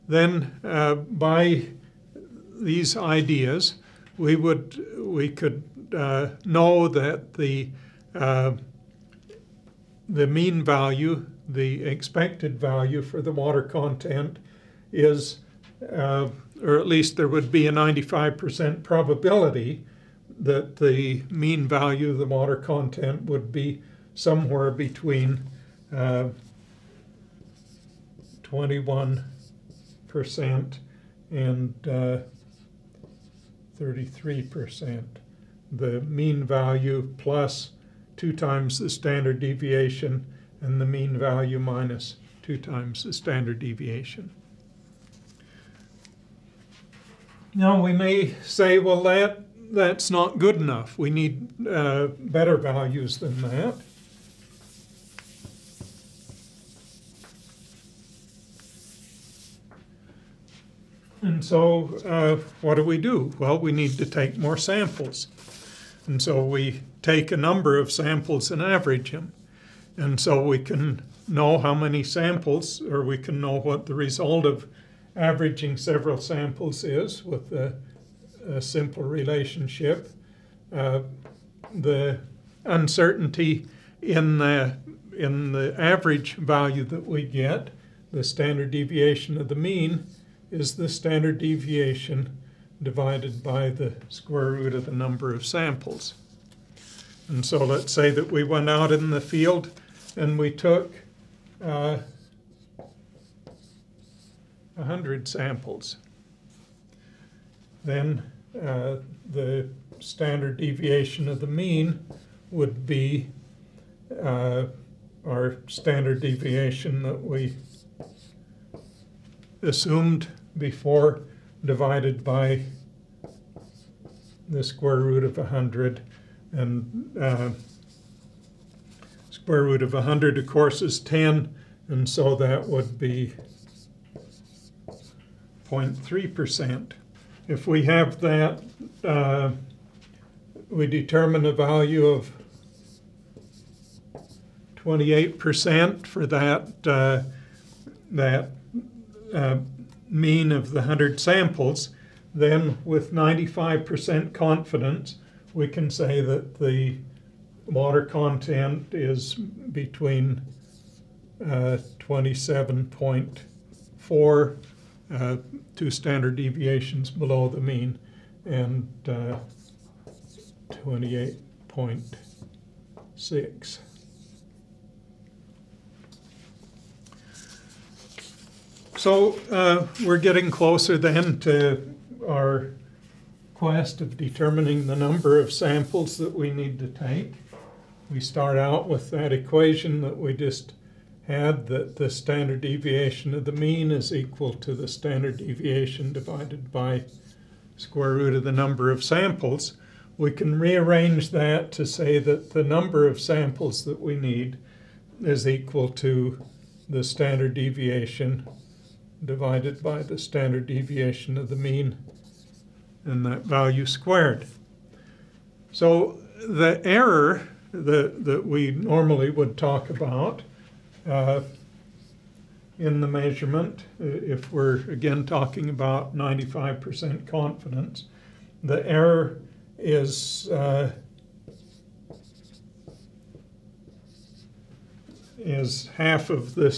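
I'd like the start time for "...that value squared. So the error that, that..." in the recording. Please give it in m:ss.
3:33.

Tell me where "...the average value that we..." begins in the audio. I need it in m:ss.
1:25.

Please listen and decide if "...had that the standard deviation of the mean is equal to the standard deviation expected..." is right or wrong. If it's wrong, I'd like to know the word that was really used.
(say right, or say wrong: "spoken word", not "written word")
wrong: "divided", not "expected".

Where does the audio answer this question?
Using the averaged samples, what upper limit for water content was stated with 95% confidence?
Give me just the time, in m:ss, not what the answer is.
2:50.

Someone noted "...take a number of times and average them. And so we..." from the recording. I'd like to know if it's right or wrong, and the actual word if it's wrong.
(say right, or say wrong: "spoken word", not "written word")
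wrong: "samples", not "times".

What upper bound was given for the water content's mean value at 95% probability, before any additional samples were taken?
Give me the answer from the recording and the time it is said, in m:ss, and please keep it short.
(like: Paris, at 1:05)
33%, at 0:33.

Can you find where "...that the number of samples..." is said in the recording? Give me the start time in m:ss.
3:22.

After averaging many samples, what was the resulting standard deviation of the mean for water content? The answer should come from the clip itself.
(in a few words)
0.3 percent.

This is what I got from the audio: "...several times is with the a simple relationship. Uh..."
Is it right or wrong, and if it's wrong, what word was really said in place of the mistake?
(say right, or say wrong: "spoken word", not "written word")
wrong: "samples", not "times".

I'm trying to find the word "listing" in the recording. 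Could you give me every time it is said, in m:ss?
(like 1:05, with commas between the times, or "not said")
not said.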